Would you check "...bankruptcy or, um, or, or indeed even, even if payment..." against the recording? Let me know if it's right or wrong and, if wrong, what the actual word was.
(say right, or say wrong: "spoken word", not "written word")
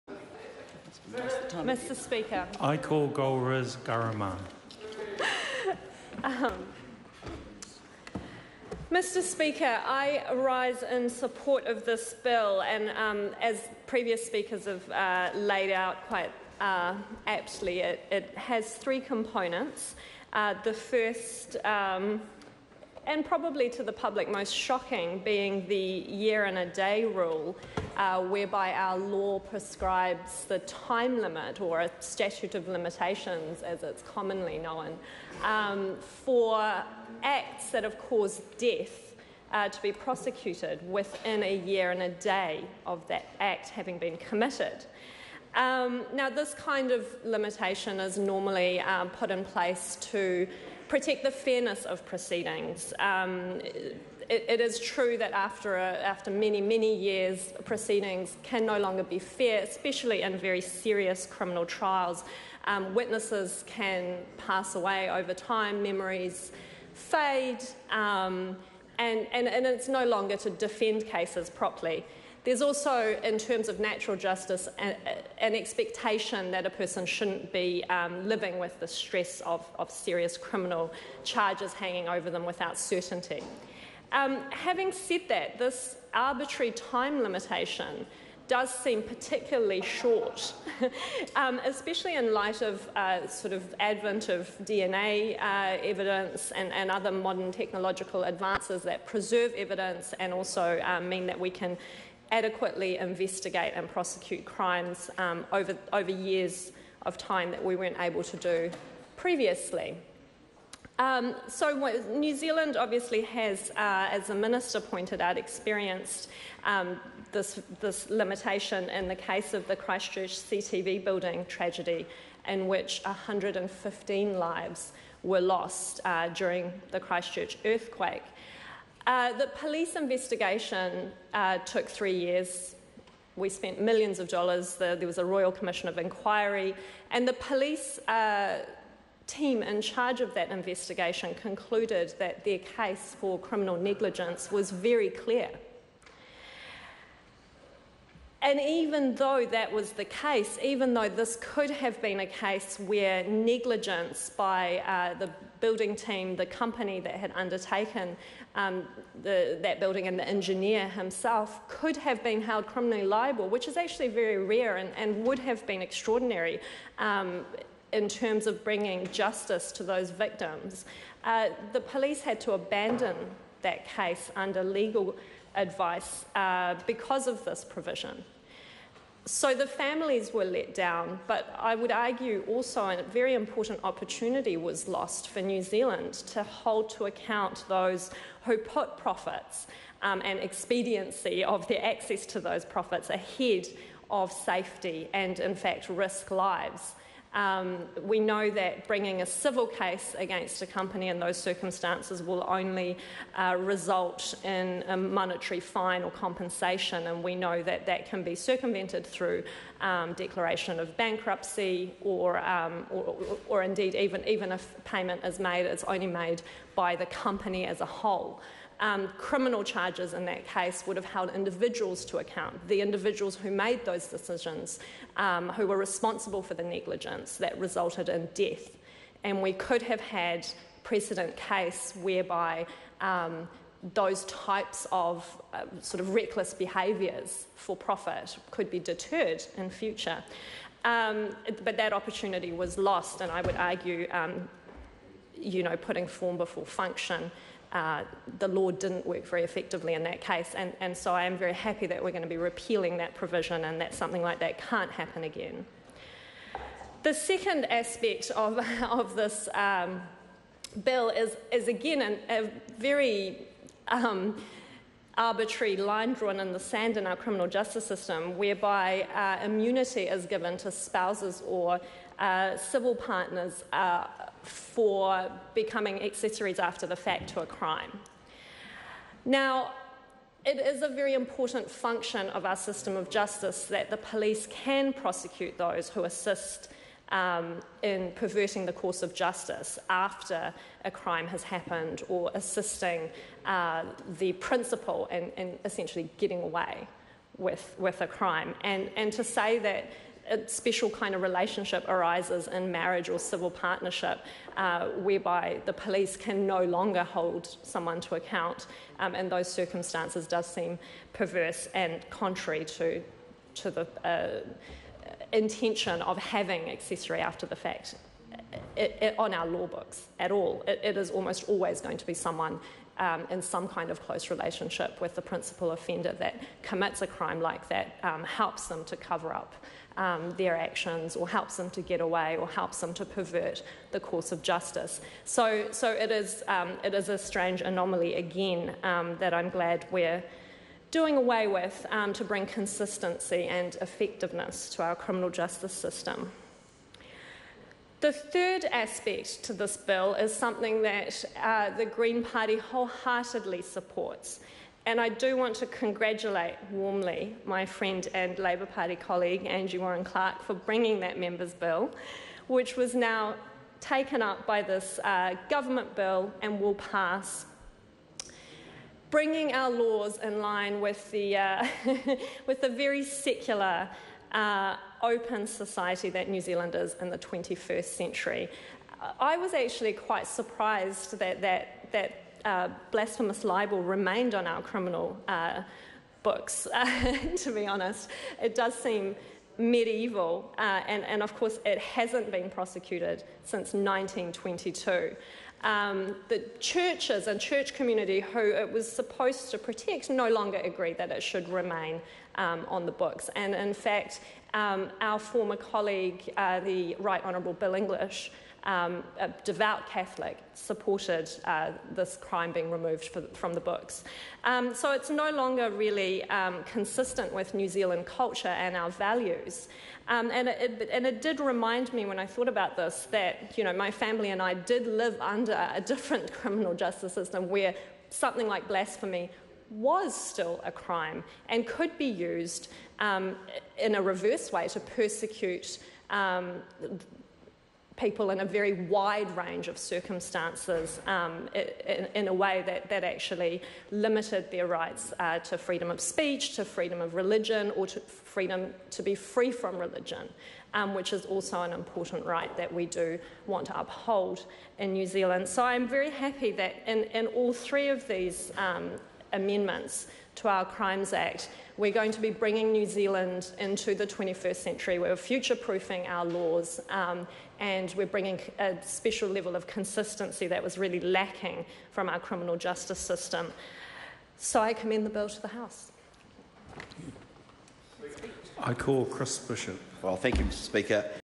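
right.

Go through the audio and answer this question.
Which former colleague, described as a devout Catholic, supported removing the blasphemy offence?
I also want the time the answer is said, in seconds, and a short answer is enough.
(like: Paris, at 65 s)
Bill English, at 407 s.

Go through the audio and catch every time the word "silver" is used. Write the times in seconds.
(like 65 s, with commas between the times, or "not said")
not said.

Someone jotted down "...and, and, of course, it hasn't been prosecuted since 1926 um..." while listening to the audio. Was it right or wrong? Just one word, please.
wrong.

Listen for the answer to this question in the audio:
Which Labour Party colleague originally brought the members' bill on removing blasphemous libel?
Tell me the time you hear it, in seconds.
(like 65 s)
359 s.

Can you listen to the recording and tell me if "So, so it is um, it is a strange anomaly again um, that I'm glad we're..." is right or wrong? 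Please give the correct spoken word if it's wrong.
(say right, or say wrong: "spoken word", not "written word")
right.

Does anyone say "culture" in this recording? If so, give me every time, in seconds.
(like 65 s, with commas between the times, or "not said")
418 s.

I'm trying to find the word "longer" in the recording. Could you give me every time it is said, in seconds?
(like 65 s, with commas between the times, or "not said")
58 s, 70 s, 306 s, 400 s, 415 s.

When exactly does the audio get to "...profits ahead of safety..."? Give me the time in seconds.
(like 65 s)
192 s.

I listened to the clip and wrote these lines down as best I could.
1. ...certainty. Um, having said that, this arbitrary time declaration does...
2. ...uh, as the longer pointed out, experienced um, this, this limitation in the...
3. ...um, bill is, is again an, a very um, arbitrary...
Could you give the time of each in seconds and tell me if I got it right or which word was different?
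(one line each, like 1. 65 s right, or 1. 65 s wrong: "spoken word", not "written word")
1. 82 s wrong: "limitation", not "declaration"
2. 113 s wrong: "minister", not "longer"
3. 259 s right.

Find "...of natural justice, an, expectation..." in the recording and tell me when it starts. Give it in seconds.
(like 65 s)
73 s.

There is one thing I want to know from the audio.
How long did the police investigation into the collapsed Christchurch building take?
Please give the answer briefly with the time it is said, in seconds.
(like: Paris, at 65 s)
3 years, at 131 s.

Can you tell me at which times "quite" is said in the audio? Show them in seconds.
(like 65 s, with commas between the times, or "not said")
16 s, 379 s.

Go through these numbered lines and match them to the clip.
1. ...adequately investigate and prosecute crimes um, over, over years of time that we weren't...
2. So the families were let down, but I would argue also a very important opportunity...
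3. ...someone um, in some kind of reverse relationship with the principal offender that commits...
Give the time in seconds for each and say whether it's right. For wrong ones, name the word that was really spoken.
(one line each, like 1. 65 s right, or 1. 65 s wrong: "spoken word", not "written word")
1. 102 s right
2. 179 s right
3. 322 s wrong: "close", not "reverse".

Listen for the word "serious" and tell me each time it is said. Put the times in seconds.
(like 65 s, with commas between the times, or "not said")
60 s, 79 s.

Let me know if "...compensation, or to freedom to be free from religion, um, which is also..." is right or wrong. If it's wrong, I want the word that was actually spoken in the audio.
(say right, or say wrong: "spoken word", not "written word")
wrong: "religion", not "compensation".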